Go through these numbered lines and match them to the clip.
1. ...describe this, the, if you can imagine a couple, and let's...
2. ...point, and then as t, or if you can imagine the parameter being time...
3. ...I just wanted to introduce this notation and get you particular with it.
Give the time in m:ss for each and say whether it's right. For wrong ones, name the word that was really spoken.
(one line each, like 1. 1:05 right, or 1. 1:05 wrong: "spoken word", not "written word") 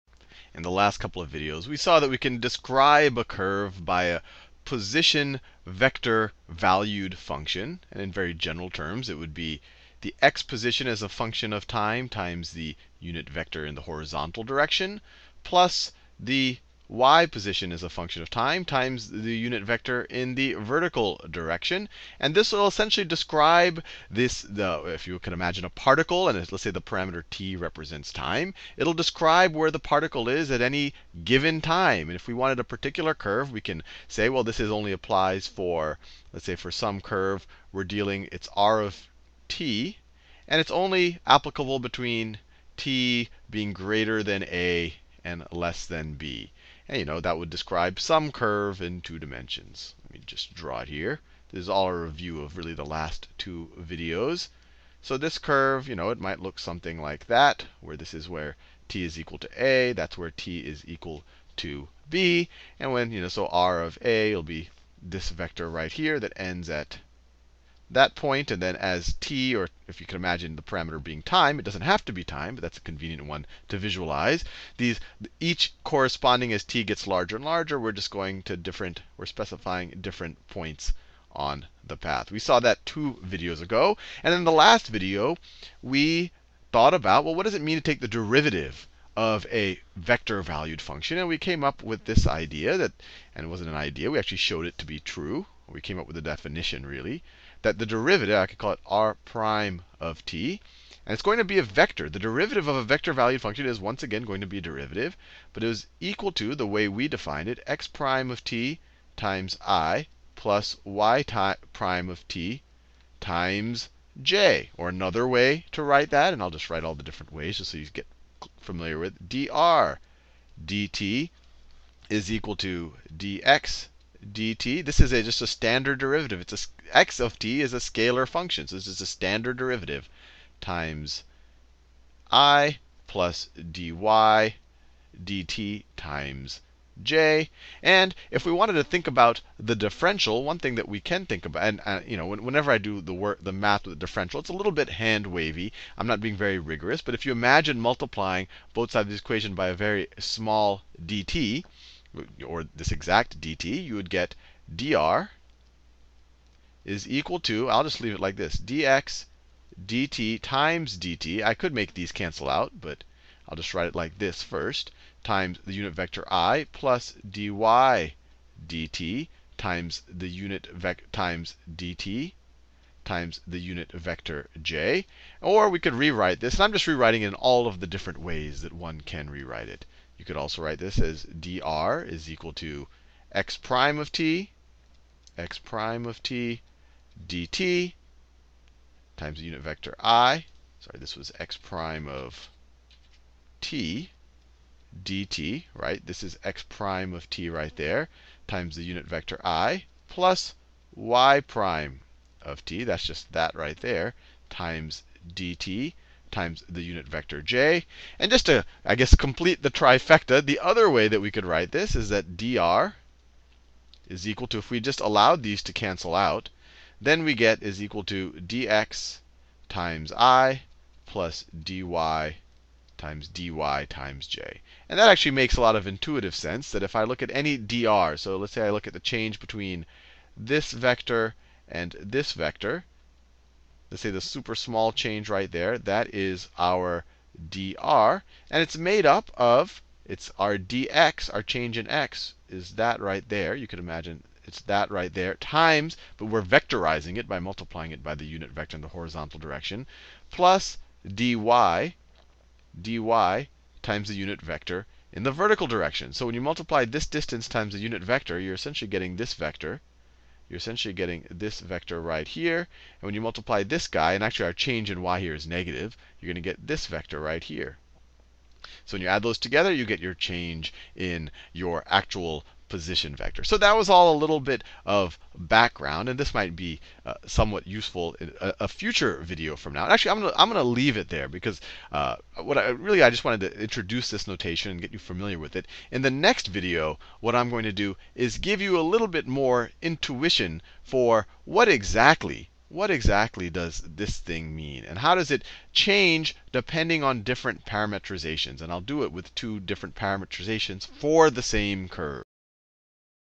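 1. 0:23 wrong: "particle", not "couple"
2. 1:08 right
3. 4:43 wrong: "familiar", not "particular".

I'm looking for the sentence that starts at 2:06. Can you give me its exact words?
It's a, x of t is a scalar function, so this is a standard derivative times i plus dy dt times j.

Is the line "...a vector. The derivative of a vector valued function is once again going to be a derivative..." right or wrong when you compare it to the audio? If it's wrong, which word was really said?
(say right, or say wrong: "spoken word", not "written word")
right.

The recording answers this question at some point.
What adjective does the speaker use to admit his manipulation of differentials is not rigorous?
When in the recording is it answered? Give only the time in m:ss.
2:24.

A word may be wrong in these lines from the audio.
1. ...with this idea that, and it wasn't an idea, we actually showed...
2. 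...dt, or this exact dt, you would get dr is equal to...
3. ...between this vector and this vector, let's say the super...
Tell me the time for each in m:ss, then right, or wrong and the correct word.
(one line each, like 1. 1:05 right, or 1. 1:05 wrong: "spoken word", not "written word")
1. 1:31 right
2. 2:31 right
3. 3:49 right.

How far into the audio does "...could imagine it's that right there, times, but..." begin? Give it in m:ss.
4:03.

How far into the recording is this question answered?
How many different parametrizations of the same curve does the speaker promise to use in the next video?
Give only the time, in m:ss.
4:59.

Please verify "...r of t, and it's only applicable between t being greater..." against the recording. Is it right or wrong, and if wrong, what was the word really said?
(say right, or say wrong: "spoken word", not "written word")
right.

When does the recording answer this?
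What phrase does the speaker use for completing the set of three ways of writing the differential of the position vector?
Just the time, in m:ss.
3:29.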